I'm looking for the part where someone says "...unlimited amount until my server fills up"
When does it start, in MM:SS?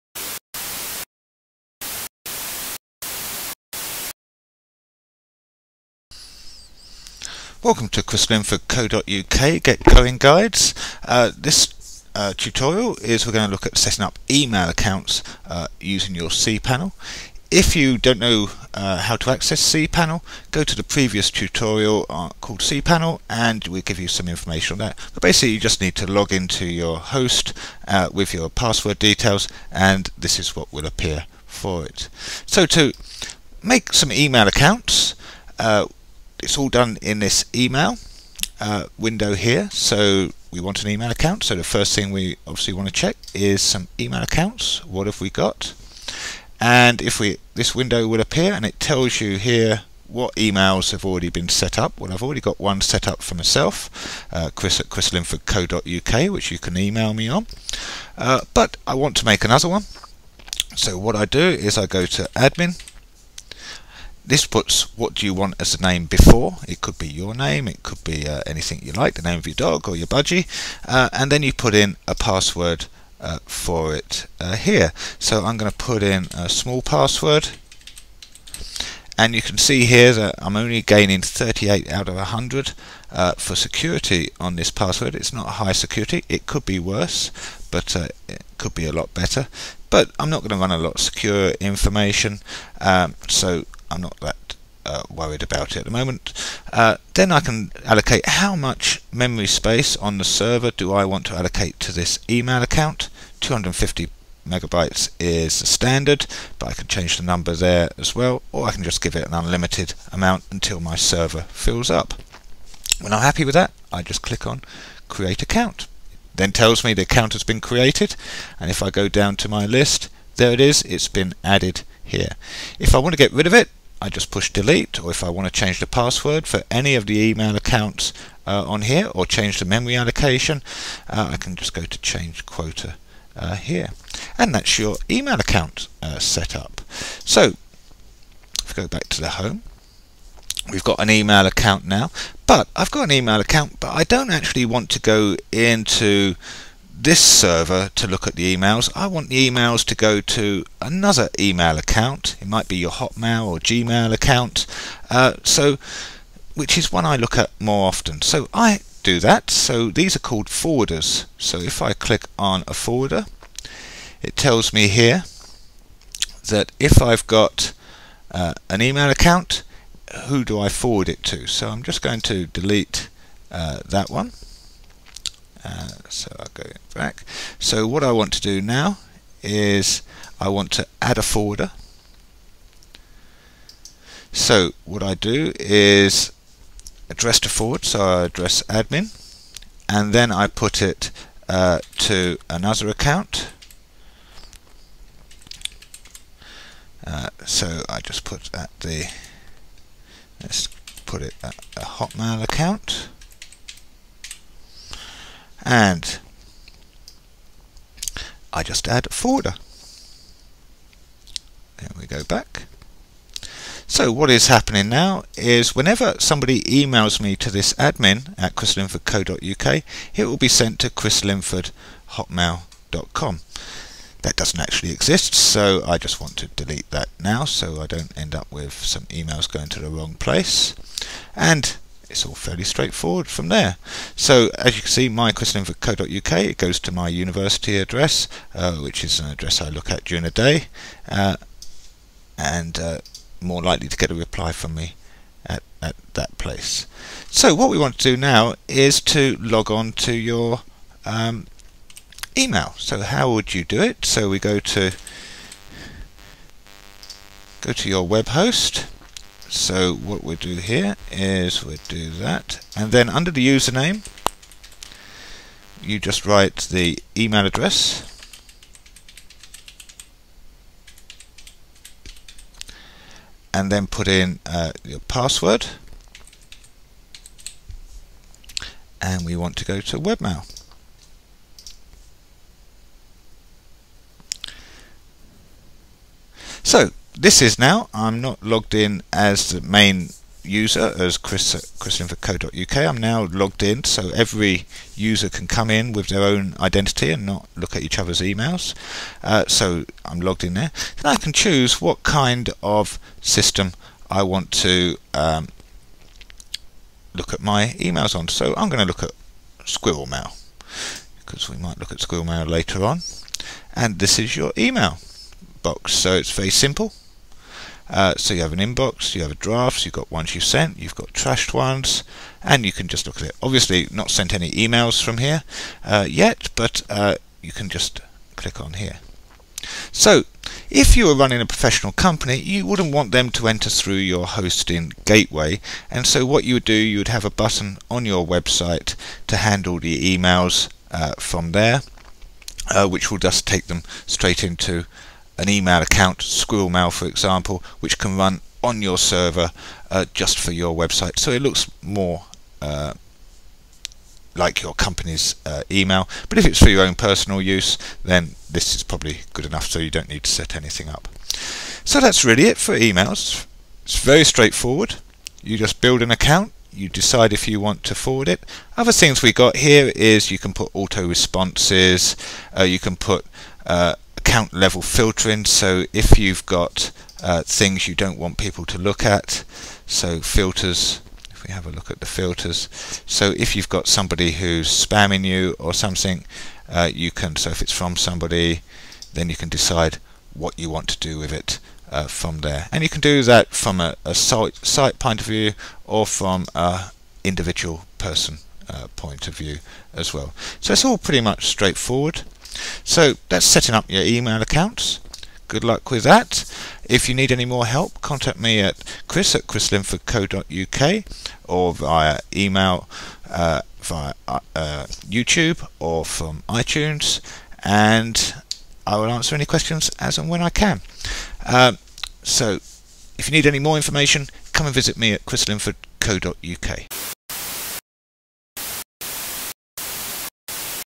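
01:49.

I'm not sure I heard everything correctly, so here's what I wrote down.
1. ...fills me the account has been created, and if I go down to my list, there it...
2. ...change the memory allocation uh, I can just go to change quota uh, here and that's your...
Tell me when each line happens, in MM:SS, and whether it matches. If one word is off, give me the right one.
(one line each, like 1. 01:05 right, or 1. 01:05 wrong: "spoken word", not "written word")
1. 01:56 wrong: "tells", not "fills"
2. 02:09 right.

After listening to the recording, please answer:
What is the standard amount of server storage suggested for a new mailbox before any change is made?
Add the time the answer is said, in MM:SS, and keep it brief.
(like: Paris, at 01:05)
250 megabytes, at 01:43.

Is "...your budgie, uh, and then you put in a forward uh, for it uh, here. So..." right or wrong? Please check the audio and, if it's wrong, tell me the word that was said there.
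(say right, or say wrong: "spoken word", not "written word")
wrong: "password", not "forward".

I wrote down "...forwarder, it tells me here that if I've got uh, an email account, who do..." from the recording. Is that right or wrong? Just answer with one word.
right.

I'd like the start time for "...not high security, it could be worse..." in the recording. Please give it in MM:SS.
01:25.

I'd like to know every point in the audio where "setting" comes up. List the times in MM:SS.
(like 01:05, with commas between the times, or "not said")
00:13, 06:43.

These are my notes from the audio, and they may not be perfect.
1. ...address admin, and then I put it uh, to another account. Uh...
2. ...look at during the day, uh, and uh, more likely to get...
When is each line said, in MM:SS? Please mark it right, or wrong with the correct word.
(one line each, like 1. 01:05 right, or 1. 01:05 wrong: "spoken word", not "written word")
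1. 03:08 right
2. 03:59 right.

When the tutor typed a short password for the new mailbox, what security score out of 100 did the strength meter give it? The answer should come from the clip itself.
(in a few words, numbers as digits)
38.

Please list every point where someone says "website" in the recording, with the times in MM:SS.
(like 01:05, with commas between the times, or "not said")
05:38, 05:50.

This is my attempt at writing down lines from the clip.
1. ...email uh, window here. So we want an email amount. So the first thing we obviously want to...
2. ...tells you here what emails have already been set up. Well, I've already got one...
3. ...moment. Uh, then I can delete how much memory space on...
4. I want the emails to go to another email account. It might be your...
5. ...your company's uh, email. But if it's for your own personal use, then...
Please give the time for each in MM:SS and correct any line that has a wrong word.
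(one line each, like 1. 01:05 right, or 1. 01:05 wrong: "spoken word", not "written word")
1. 00:37 wrong: "account", not "amount"
2. 00:48 right
3. 01:35 wrong: "allocate", not "delete"
4. 02:28 right
5. 05:54 right.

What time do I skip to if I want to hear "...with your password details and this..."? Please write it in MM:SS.
00:28.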